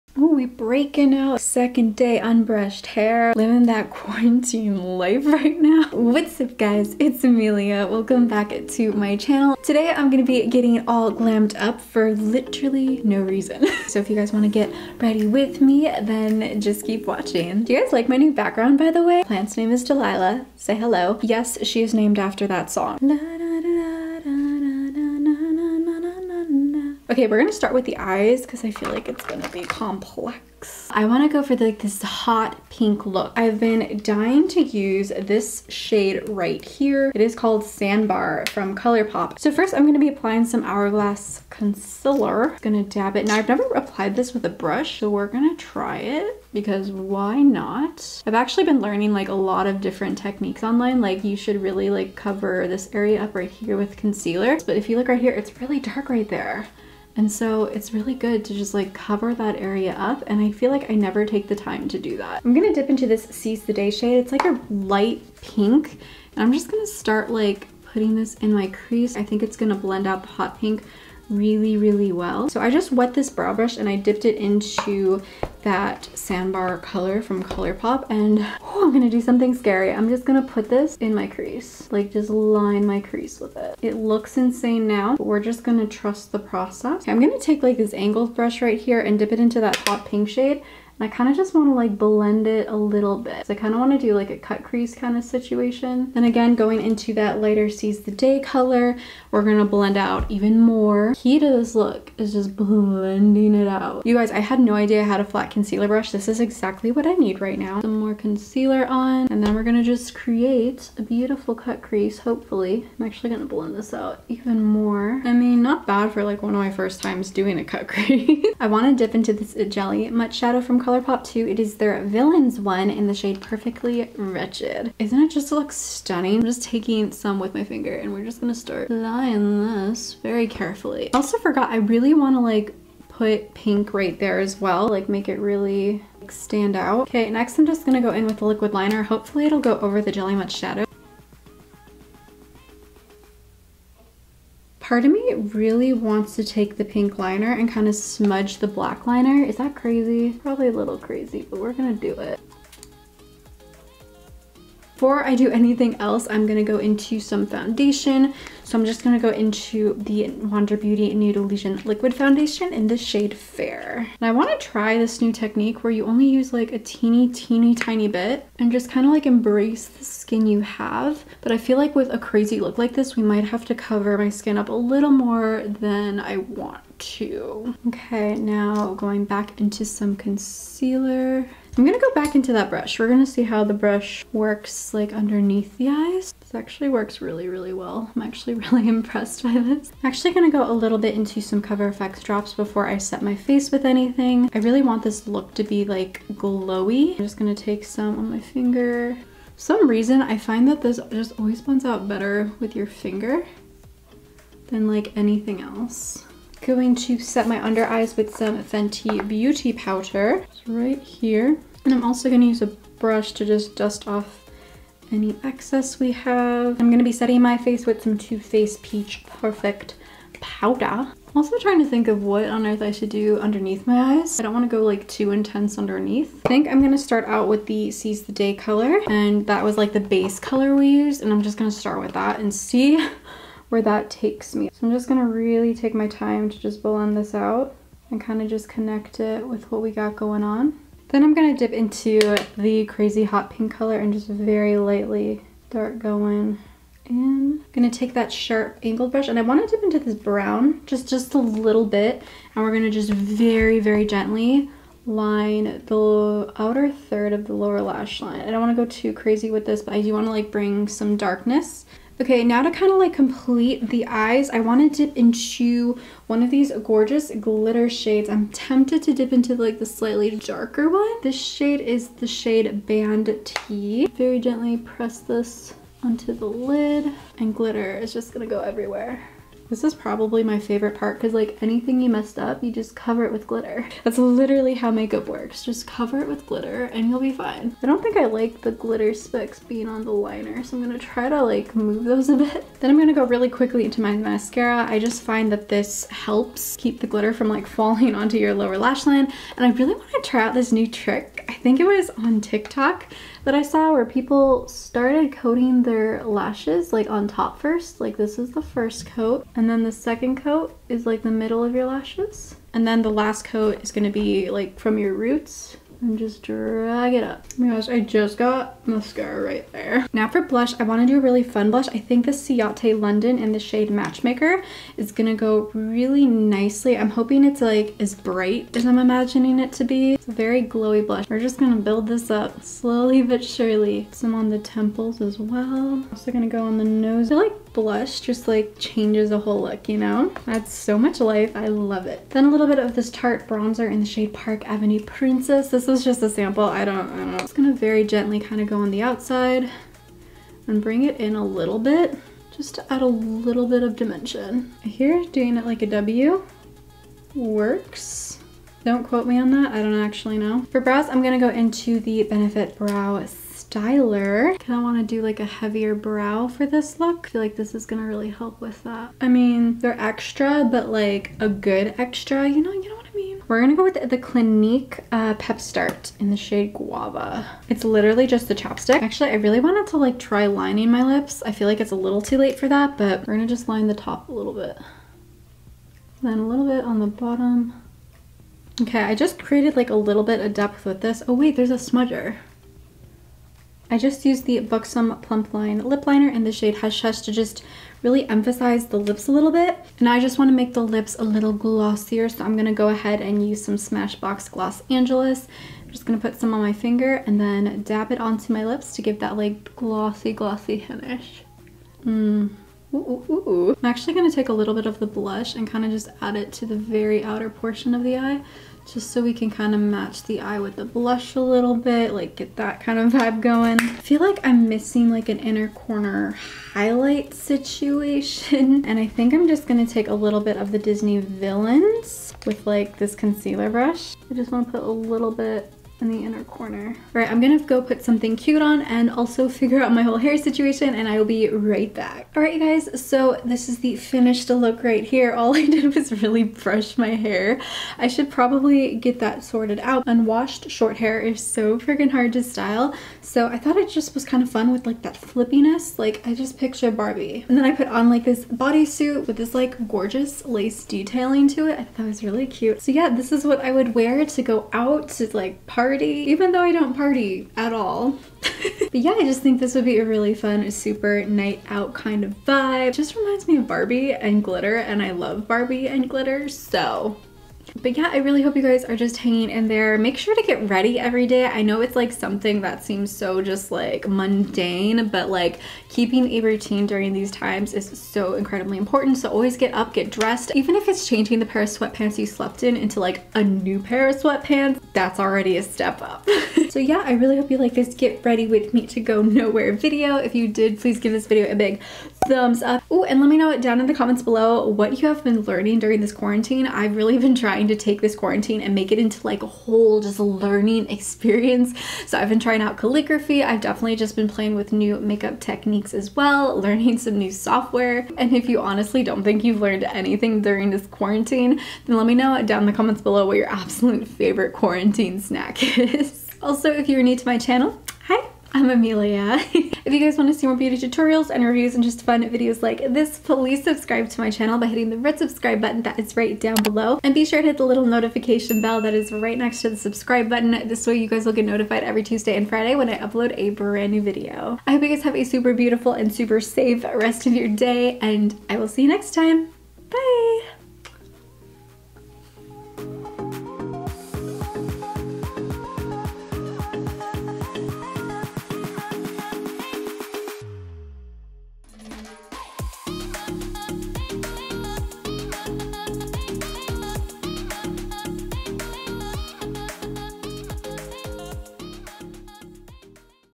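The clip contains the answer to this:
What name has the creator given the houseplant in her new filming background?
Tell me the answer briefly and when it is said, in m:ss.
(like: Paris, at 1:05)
Delilah, at 0:19.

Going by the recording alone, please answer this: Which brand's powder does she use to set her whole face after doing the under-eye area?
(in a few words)
Too Faced.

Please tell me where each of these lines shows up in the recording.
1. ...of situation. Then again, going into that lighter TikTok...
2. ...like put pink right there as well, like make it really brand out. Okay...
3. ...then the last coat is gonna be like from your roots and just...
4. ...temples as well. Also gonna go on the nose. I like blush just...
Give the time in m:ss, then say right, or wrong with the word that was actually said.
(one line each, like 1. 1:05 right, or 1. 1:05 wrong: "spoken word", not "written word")
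1. 1:35 wrong: "Seas", not "TikTok"
2. 2:12 wrong: "stand", not "brand"
3. 5:12 right
4. 5:34 right.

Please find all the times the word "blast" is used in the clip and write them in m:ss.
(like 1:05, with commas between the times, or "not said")
not said.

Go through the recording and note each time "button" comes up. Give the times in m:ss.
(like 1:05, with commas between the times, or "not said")
8:55, 9:00.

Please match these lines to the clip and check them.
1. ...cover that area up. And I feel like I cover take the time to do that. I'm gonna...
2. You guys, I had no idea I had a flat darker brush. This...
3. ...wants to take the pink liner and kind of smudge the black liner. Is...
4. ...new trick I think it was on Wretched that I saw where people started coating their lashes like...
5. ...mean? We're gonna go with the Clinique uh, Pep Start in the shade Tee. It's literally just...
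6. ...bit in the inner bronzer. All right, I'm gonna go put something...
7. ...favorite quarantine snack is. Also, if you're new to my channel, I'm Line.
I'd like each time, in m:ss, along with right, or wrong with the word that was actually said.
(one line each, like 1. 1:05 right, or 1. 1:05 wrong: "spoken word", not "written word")
1. 0:58 wrong: "never", not "cover"
2. 1:44 wrong: "concealer", not "darker"
3. 2:25 right
4. 5:00 wrong: "TikTok", not "Wretched"
5. 6:13 wrong: "Guava", not "Tee"
6. 7:15 wrong: "corner", not "bronzer"
7. 8:44 wrong: "Emelia", not "Line".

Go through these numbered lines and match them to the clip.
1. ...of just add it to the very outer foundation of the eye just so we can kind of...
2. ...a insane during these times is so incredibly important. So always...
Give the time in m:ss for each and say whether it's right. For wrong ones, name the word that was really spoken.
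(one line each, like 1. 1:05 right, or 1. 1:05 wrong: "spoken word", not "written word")
1. 6:55 wrong: "portion", not "foundation"
2. 8:06 wrong: "routine", not "insane".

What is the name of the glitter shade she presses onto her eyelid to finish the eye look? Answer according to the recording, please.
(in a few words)
Band Tee.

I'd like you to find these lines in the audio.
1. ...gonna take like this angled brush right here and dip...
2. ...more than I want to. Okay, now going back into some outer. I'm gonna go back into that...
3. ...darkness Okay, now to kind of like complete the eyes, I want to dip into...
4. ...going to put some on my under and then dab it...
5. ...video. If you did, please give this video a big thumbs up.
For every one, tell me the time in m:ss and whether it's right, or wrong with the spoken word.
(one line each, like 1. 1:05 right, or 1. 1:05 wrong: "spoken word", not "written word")
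1. 1:27 right
2. 2:55 wrong: "concealer", not "outer"
3. 4:21 right
4. 6:46 wrong: "finger", not "under"
5. 8:19 right.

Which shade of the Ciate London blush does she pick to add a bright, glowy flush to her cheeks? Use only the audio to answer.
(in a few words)
Matchmaker.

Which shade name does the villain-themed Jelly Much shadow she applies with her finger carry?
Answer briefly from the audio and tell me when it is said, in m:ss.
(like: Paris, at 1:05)
Perfectly Wretched, at 2:03.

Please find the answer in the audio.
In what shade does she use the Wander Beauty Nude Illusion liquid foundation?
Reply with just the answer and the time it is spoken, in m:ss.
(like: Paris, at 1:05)
Fair, at 2:43.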